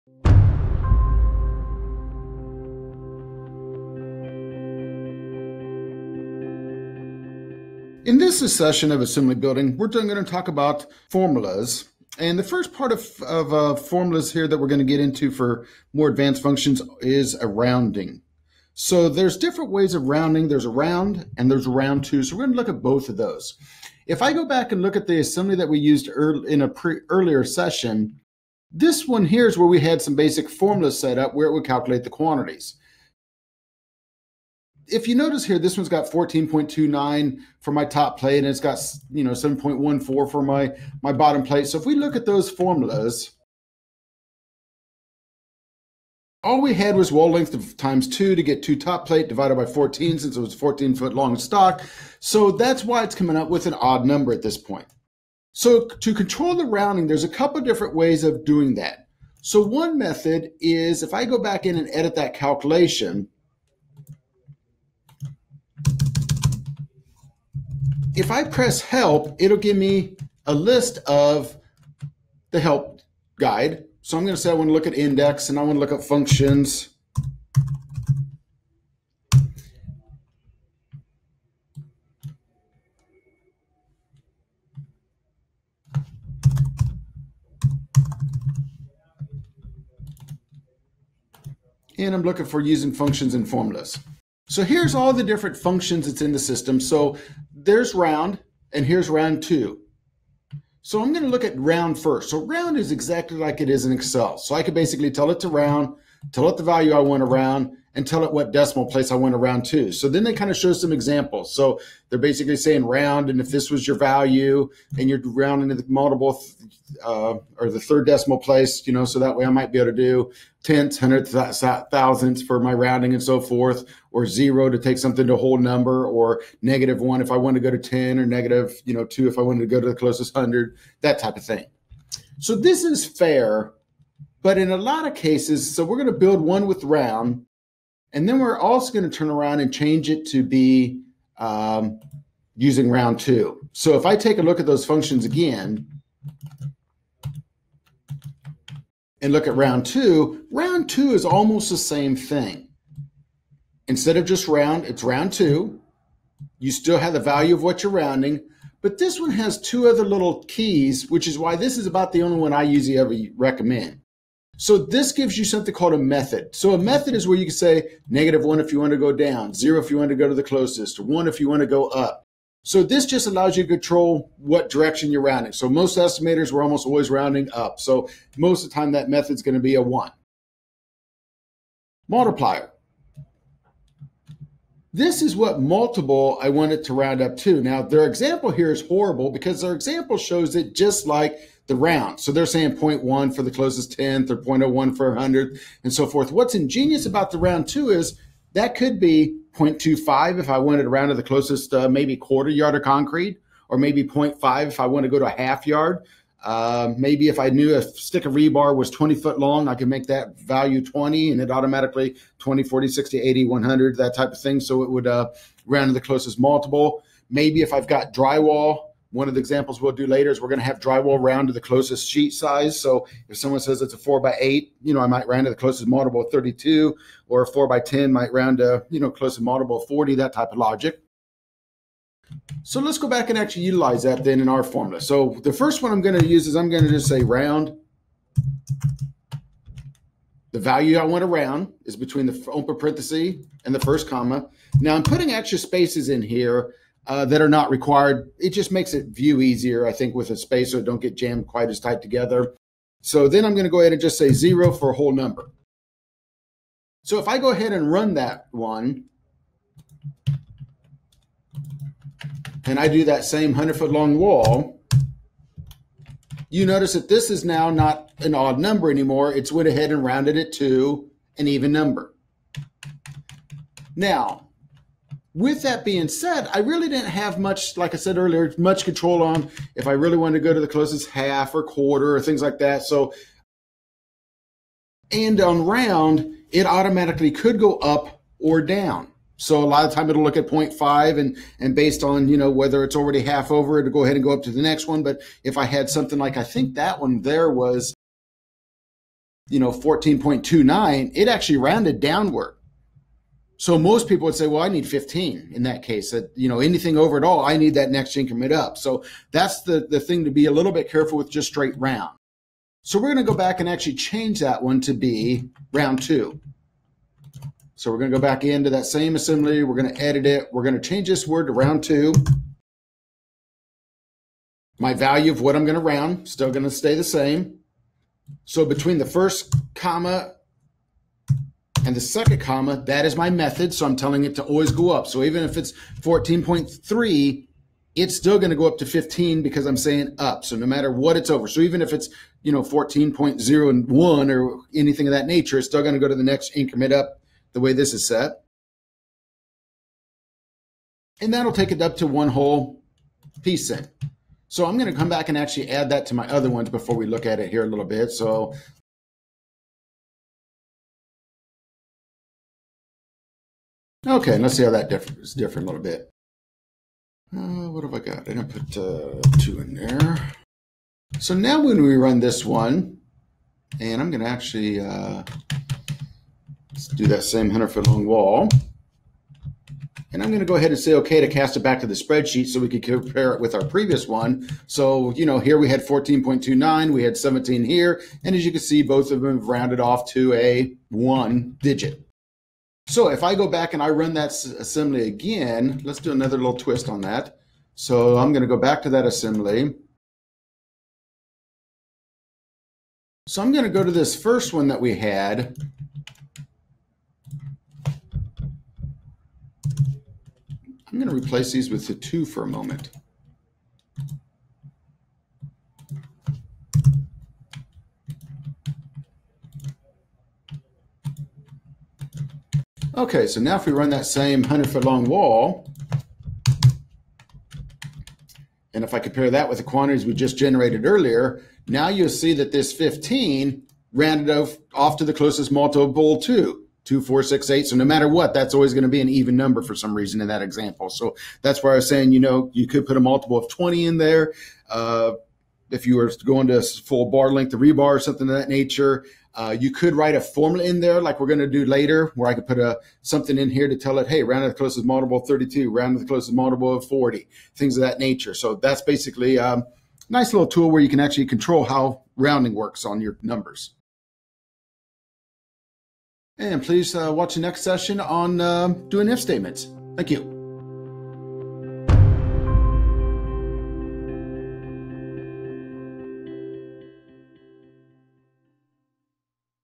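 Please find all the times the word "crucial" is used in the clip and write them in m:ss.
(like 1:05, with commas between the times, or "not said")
not said.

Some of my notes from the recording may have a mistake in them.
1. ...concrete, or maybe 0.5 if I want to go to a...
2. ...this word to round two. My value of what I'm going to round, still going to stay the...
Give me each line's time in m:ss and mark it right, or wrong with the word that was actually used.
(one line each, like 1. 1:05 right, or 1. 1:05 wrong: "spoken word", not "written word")
1. 3:22 right
2. 5:21 right.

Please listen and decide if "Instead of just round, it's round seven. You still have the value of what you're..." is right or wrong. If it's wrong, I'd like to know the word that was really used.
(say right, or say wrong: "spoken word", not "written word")
wrong: "two", not "seven".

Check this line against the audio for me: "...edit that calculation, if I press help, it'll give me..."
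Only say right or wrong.
right.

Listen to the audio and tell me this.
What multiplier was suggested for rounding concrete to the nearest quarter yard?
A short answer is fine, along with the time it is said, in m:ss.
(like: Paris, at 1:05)
0.25, at 3:19.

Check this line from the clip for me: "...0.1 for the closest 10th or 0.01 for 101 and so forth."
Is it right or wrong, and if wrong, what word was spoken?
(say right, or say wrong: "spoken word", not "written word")
wrong: "100", not "101".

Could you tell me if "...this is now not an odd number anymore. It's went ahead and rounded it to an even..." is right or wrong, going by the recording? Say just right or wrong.
right.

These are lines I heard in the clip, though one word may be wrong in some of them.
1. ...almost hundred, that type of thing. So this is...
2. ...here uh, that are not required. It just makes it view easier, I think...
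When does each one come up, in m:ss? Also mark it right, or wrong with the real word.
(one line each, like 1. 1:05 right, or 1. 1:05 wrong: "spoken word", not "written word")
1. 2:09 wrong: "closest", not "almost"
2. 4:06 right.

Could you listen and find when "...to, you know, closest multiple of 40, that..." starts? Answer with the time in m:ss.
3:48.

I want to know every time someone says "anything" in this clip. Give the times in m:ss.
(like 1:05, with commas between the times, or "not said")
5:06, 5:44.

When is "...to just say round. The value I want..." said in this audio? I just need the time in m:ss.
3:56.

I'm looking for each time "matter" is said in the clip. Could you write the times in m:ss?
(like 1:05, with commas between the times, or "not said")
5:40, 7:17.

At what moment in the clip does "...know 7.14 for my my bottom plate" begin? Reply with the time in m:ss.
0:39.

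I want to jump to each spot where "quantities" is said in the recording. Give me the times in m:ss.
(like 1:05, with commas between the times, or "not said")
0:32, 7:09.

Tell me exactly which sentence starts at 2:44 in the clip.
So this gives you something called a method.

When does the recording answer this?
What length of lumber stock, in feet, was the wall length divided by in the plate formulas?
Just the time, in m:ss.
0:50.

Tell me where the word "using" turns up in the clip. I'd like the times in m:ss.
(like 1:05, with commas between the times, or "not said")
1:32, 2:22.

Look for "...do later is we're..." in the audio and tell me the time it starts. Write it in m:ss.
3:39.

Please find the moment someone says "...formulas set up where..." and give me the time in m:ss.
0:30.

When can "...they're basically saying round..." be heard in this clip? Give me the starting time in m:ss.
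1:52.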